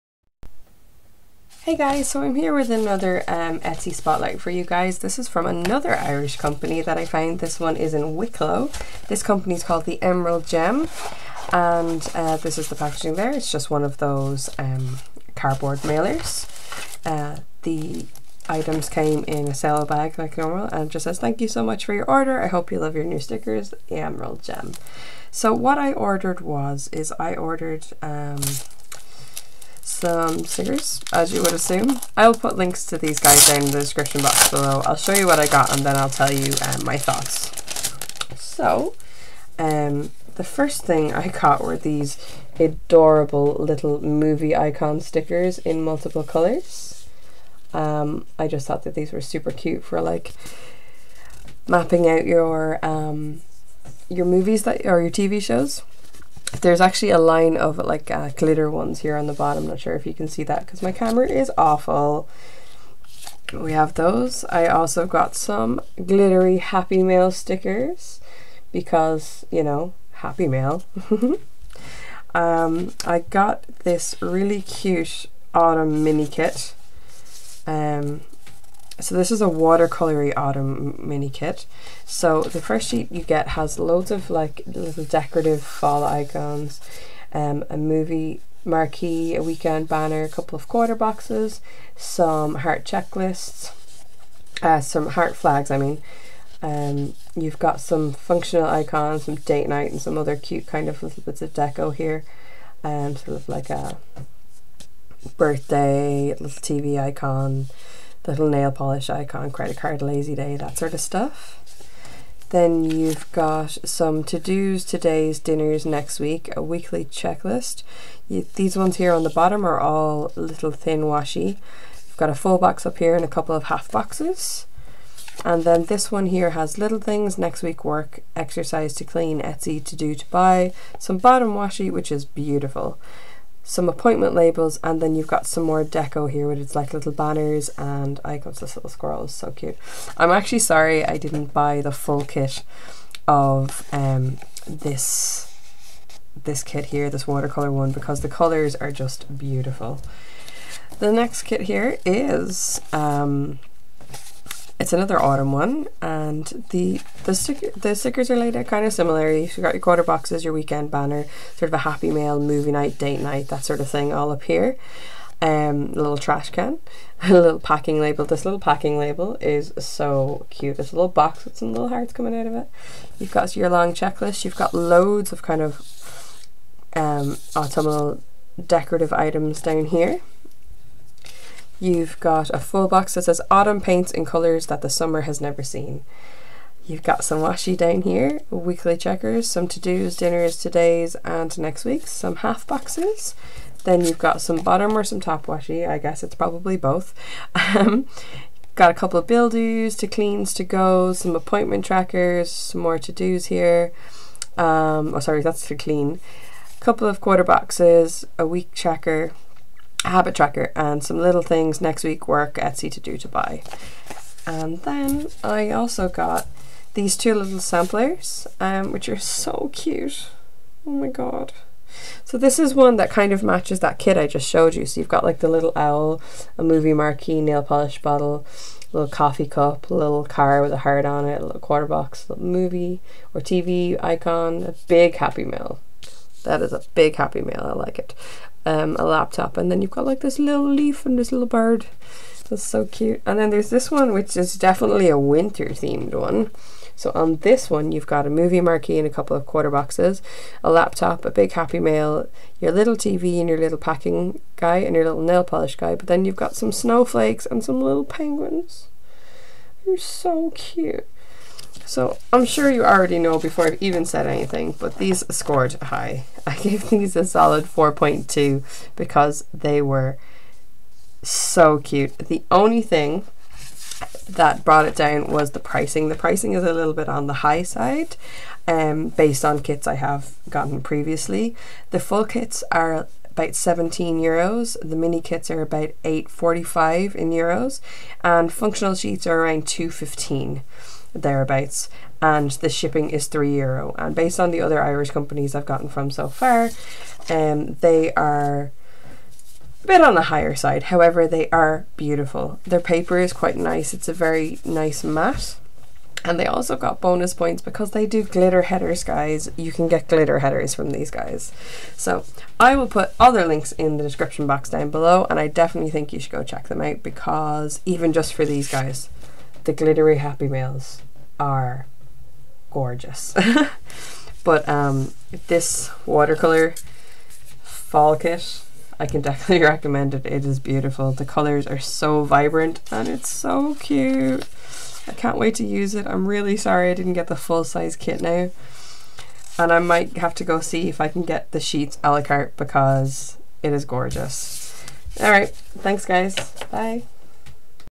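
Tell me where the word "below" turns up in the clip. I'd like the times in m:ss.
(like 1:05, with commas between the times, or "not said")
0:34, 5:14.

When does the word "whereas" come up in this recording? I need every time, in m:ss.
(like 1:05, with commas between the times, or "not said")
not said.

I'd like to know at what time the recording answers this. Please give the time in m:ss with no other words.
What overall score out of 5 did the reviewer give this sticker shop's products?
4:27.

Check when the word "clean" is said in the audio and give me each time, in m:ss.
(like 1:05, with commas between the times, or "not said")
2:09, 3:20, 3:25.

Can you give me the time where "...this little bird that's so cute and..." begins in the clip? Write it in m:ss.
4:01.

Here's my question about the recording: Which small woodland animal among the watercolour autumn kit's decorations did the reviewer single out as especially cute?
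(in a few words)
squirrel.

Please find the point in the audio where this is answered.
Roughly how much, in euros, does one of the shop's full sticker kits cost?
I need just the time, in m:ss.
4:43.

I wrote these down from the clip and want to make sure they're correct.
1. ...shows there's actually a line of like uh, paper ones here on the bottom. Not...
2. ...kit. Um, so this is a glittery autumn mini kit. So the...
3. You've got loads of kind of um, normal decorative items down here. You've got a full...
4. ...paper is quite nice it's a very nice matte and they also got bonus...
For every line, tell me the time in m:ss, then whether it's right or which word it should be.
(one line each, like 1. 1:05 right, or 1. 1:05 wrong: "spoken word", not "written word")
1. 0:55 wrong: "glitter", not "paper"
2. 1:16 wrong: "watercolory", not "glittery"
3. 2:54 wrong: "autumnal", not "normal"
4. 5:02 right.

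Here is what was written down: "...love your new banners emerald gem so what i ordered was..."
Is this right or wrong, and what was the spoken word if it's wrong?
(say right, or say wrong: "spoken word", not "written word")
wrong: "stickers", not "banners".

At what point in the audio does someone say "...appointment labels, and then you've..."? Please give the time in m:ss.
2:13.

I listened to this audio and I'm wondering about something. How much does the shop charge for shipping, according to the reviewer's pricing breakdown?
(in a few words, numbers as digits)
3 euro.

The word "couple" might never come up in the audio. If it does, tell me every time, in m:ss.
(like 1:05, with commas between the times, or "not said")
1:30, 2:03, 3:18, 3:26, 4:09.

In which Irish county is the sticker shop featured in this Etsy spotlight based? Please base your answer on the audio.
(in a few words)
Wicklow.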